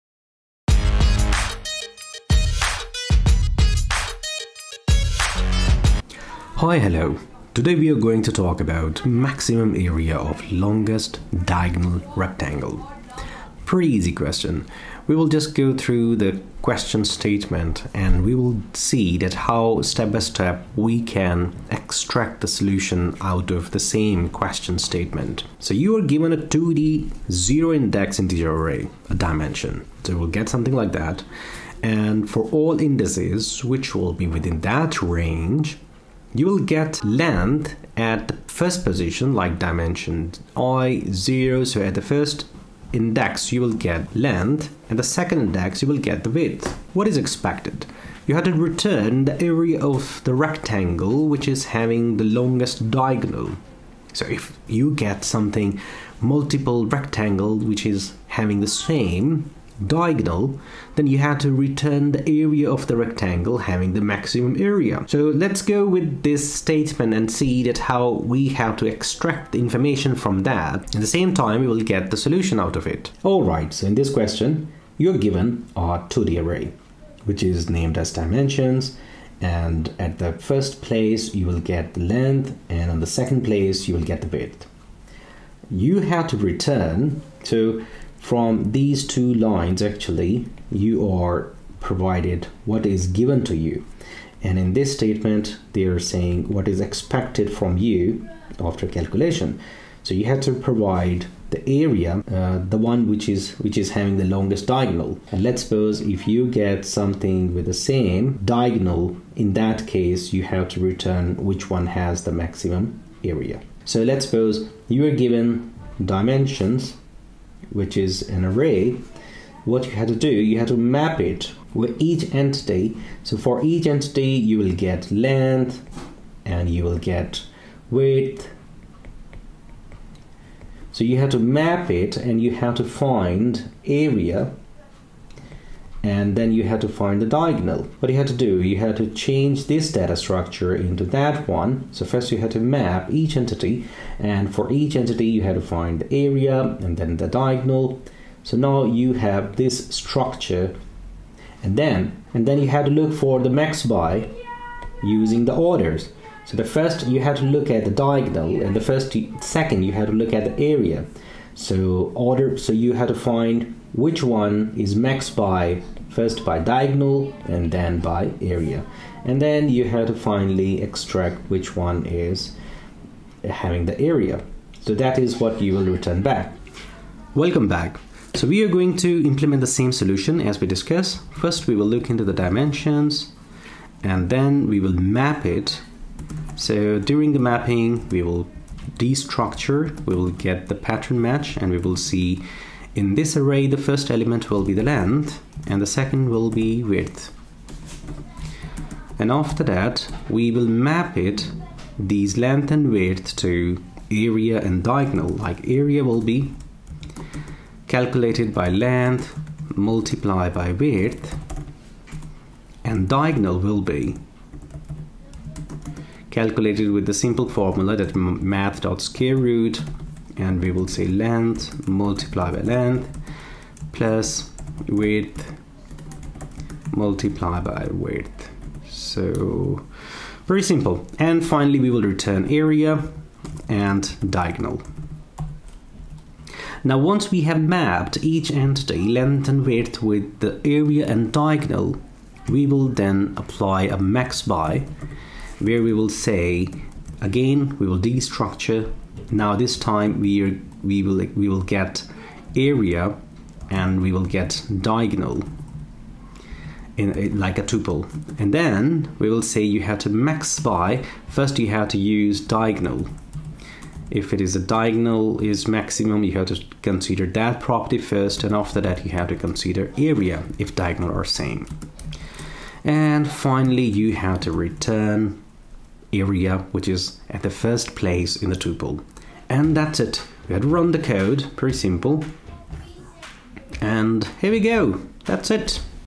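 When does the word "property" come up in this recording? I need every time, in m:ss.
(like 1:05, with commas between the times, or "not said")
4:27.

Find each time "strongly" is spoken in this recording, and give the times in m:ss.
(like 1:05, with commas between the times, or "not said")
not said.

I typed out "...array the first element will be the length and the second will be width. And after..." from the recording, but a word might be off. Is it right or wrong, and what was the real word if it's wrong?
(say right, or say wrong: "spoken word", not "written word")
right.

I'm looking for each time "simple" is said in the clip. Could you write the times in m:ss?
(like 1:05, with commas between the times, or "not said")
3:37, 3:50, 4:41.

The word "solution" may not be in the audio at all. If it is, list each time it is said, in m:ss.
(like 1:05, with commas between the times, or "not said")
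0:22, 1:12, 2:59.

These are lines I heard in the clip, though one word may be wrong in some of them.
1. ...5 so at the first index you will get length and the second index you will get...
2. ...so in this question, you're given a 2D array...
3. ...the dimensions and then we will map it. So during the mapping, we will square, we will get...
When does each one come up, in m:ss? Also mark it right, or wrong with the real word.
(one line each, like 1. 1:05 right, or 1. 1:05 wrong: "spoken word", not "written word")
1. 0:41 wrong: "0", not "5"
2. 1:13 right
3. 3:02 wrong: "destructure", not "square".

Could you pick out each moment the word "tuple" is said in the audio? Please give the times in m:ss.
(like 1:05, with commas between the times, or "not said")
4:17, 4:38.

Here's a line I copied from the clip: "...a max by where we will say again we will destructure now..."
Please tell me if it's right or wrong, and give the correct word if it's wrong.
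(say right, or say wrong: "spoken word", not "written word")
right.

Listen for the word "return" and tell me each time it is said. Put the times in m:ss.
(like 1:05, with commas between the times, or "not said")
0:48, 1:01, 1:26, 1:50, 2:55, 3:52, 4:34.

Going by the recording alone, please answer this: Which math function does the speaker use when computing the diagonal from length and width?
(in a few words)
square root.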